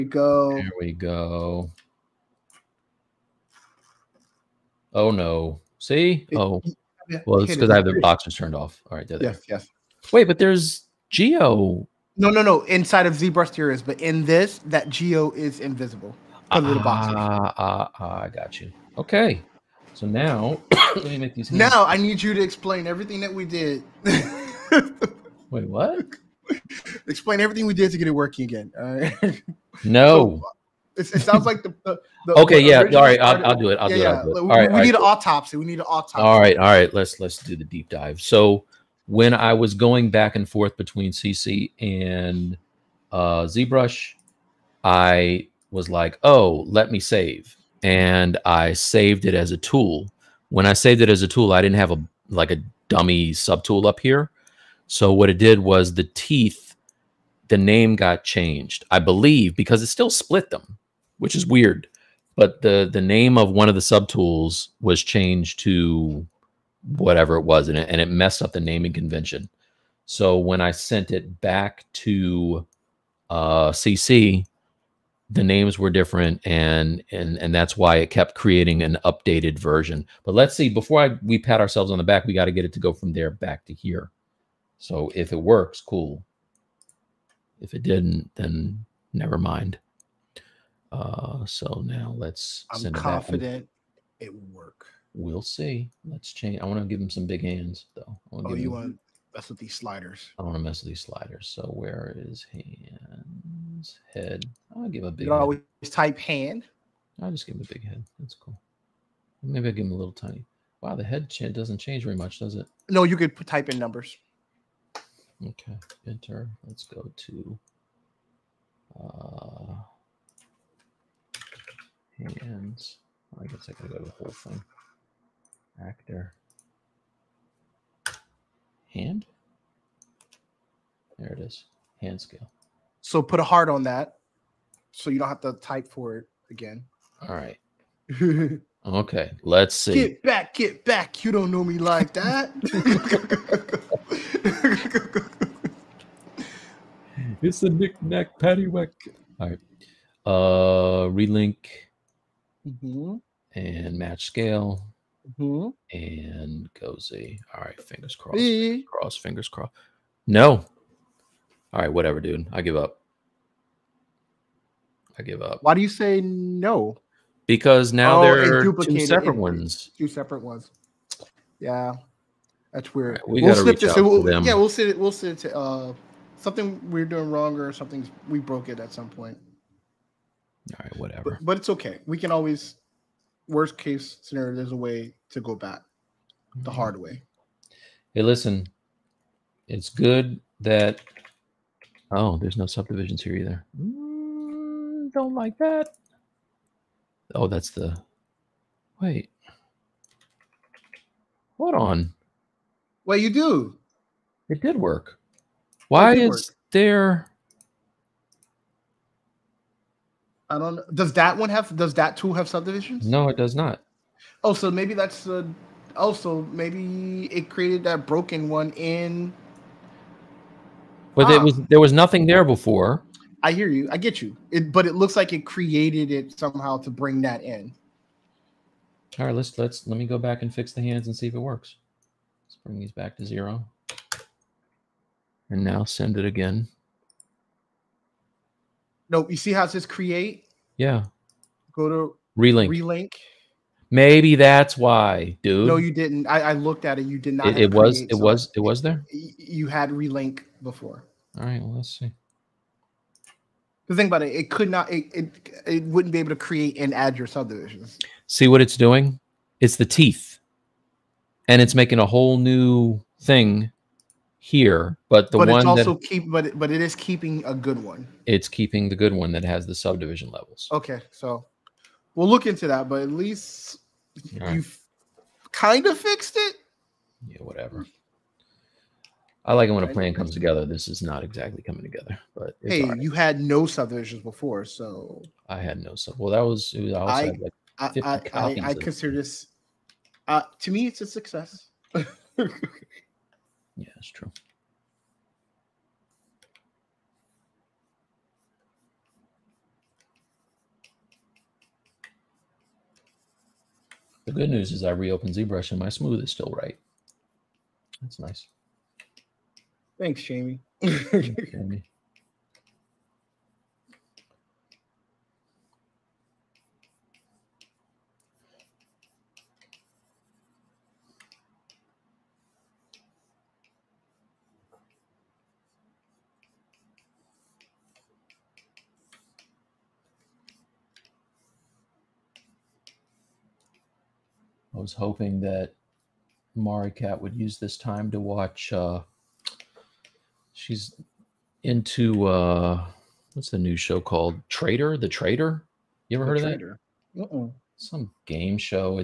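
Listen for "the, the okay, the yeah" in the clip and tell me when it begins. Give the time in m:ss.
0:31.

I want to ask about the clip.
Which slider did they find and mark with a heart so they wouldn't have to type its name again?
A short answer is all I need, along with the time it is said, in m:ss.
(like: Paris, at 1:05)
Hand scale, at 2:12.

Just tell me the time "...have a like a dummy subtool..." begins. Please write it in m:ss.
0:51.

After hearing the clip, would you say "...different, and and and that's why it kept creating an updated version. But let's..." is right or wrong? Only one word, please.
right.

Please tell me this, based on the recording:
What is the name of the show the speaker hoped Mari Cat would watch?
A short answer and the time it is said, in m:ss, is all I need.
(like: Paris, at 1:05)
The Trader, at 5:44.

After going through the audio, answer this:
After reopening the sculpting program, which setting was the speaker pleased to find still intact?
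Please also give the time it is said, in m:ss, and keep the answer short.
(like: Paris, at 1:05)
smooth, at 5:05.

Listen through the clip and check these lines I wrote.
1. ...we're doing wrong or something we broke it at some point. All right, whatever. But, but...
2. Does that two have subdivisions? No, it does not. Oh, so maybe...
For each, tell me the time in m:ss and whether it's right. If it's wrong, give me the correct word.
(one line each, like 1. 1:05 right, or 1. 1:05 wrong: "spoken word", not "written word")
1. 2:56 right
2. 3:31 right.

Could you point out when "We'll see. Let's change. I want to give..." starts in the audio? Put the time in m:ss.
1:35.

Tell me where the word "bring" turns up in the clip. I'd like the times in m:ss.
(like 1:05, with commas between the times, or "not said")
3:46, 3:52.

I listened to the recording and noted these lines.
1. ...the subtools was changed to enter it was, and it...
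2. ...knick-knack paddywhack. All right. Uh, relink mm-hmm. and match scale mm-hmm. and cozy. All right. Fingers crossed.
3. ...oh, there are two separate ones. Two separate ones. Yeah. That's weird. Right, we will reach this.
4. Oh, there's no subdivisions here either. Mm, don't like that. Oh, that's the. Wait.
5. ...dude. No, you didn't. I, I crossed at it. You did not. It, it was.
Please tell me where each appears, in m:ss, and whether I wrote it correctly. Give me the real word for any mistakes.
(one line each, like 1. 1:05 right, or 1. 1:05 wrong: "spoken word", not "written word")
1. 1:03 wrong: "whatever", not "enter"
2. 2:27 right
3. 2:48 right
4. 3:12 right
5. 4:05 wrong: "looked", not "crossed".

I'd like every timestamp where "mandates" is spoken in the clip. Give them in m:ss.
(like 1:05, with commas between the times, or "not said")
not said.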